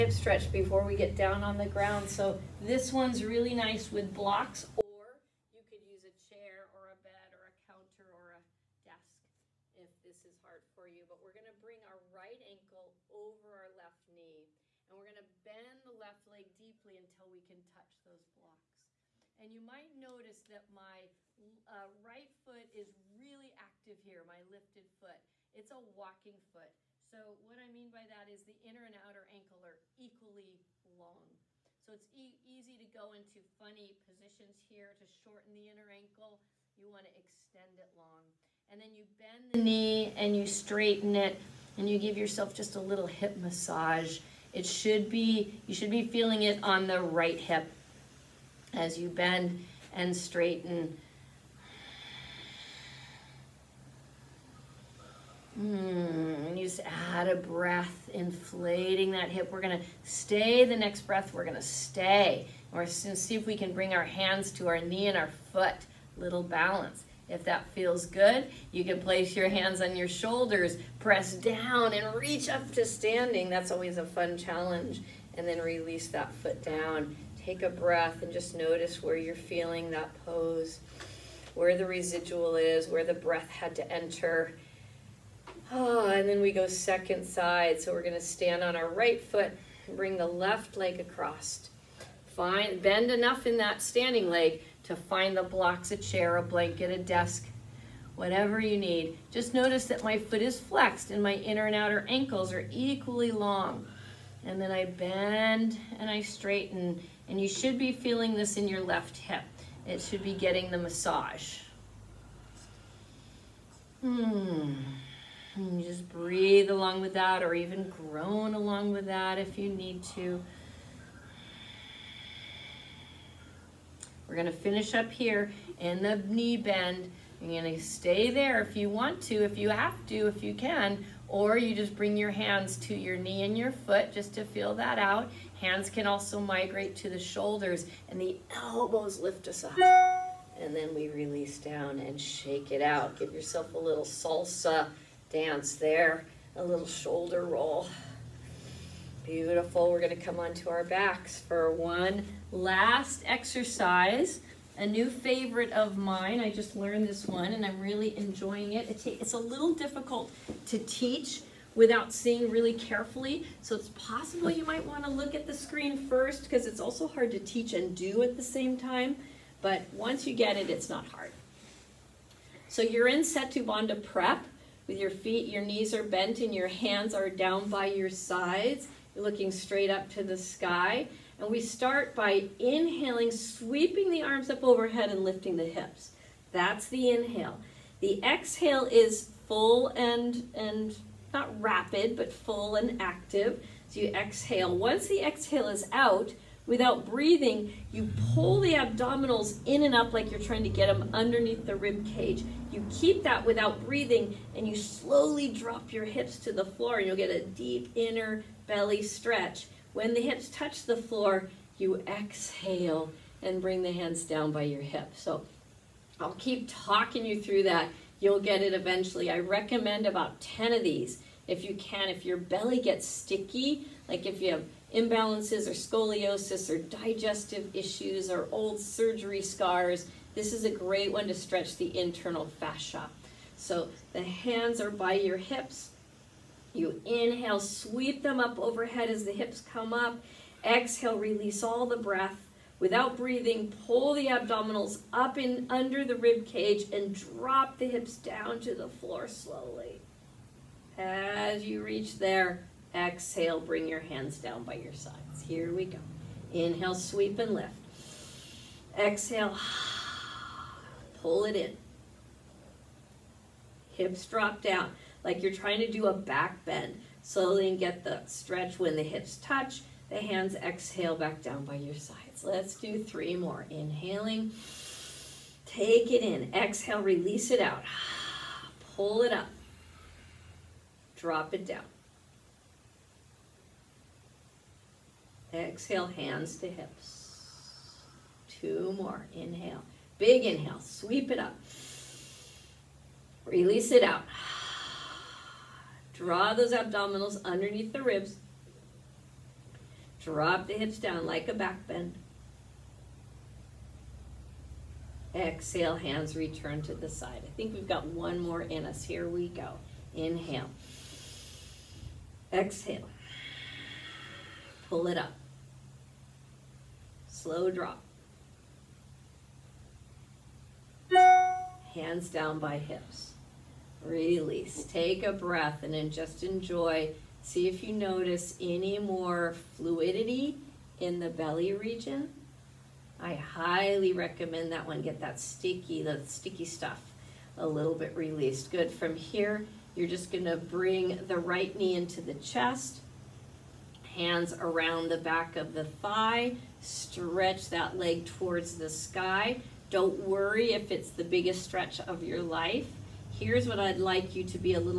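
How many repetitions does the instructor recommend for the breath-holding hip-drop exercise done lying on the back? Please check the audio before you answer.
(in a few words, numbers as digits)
10.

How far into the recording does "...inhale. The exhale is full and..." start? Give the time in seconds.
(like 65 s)
187 s.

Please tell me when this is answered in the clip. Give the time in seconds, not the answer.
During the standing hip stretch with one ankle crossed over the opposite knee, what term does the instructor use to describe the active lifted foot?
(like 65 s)
25 s.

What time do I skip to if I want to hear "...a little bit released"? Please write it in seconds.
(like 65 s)
337 s.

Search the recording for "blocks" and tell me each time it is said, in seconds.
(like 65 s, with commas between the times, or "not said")
4 s, 18 s, 95 s.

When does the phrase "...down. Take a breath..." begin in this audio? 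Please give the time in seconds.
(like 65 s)
76 s.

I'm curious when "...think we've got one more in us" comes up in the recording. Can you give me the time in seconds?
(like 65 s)
307 s.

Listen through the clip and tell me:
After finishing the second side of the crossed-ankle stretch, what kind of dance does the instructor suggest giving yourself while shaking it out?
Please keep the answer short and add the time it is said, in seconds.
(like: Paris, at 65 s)
salsa dance, at 144 s.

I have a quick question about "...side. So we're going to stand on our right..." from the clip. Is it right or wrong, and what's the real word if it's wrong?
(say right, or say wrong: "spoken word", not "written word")
right.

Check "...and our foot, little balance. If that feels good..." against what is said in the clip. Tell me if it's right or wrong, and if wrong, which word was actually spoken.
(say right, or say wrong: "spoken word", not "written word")
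right.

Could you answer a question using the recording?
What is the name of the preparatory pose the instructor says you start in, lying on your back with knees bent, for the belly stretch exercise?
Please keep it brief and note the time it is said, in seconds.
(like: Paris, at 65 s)
Setu Bandha prep, at 173 s.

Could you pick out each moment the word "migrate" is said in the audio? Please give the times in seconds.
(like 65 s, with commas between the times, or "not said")
136 s.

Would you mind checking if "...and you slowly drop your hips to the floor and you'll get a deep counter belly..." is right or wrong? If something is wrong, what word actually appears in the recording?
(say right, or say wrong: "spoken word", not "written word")
wrong: "inner", not "counter".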